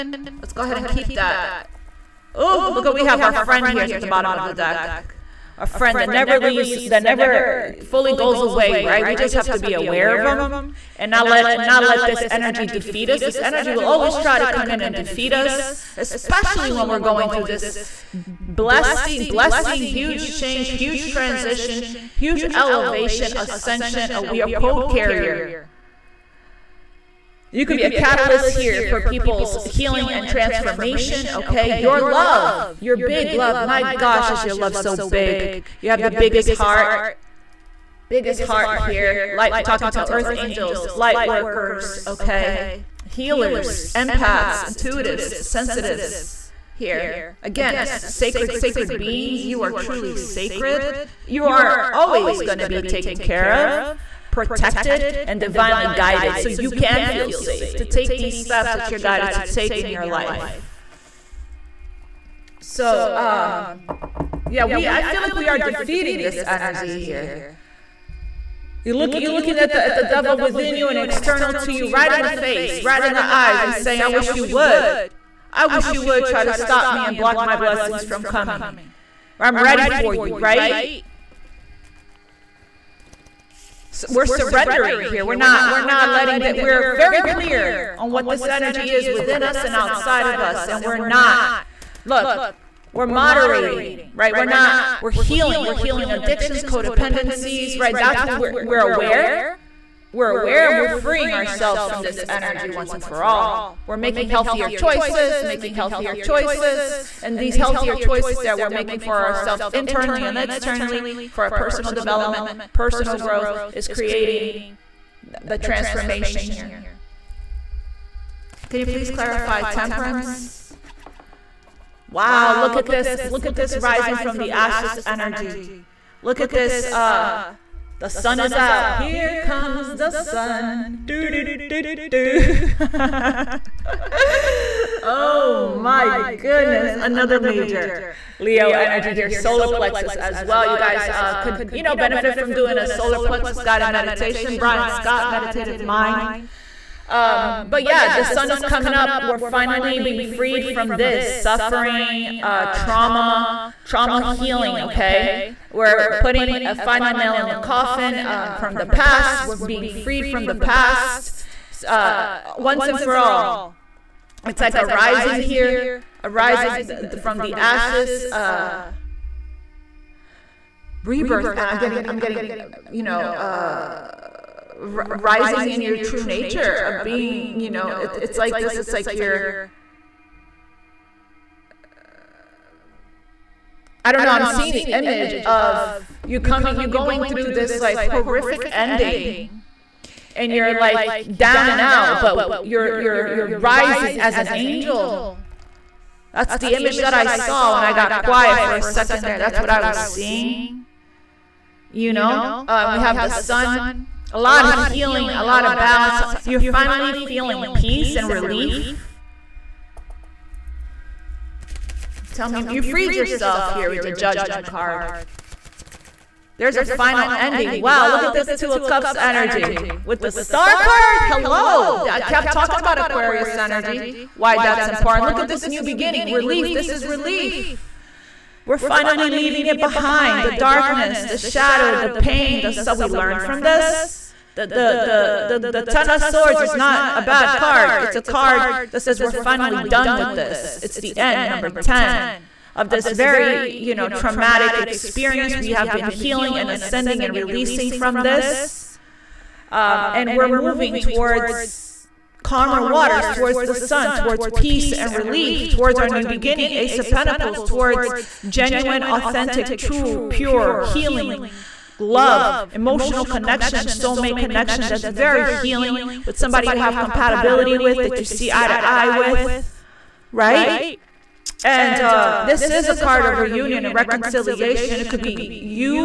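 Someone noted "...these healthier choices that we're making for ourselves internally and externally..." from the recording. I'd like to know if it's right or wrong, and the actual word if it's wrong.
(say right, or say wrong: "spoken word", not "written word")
right.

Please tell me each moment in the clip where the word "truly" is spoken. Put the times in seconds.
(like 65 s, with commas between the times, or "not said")
49 s.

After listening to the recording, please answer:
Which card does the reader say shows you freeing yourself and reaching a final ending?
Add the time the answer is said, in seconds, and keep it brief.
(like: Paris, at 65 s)
Judgment, at 214 s.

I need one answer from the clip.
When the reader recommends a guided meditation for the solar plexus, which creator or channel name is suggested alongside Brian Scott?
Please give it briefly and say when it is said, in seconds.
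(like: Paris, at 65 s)
Meditative Mind, at 145 s.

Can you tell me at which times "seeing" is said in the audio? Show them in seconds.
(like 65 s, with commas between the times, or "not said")
184 s, 199 s.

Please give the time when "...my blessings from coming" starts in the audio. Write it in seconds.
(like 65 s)
77 s.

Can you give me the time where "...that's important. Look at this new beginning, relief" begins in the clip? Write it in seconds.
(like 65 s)
224 s.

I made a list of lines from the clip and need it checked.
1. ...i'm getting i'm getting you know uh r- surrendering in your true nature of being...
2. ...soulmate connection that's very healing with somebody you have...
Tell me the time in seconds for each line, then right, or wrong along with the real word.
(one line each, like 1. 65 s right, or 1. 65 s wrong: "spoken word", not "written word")
1. 171 s wrong: "rising", not "surrendering"
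2. 263 s right.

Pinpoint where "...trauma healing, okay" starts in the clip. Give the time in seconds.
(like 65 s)
153 s.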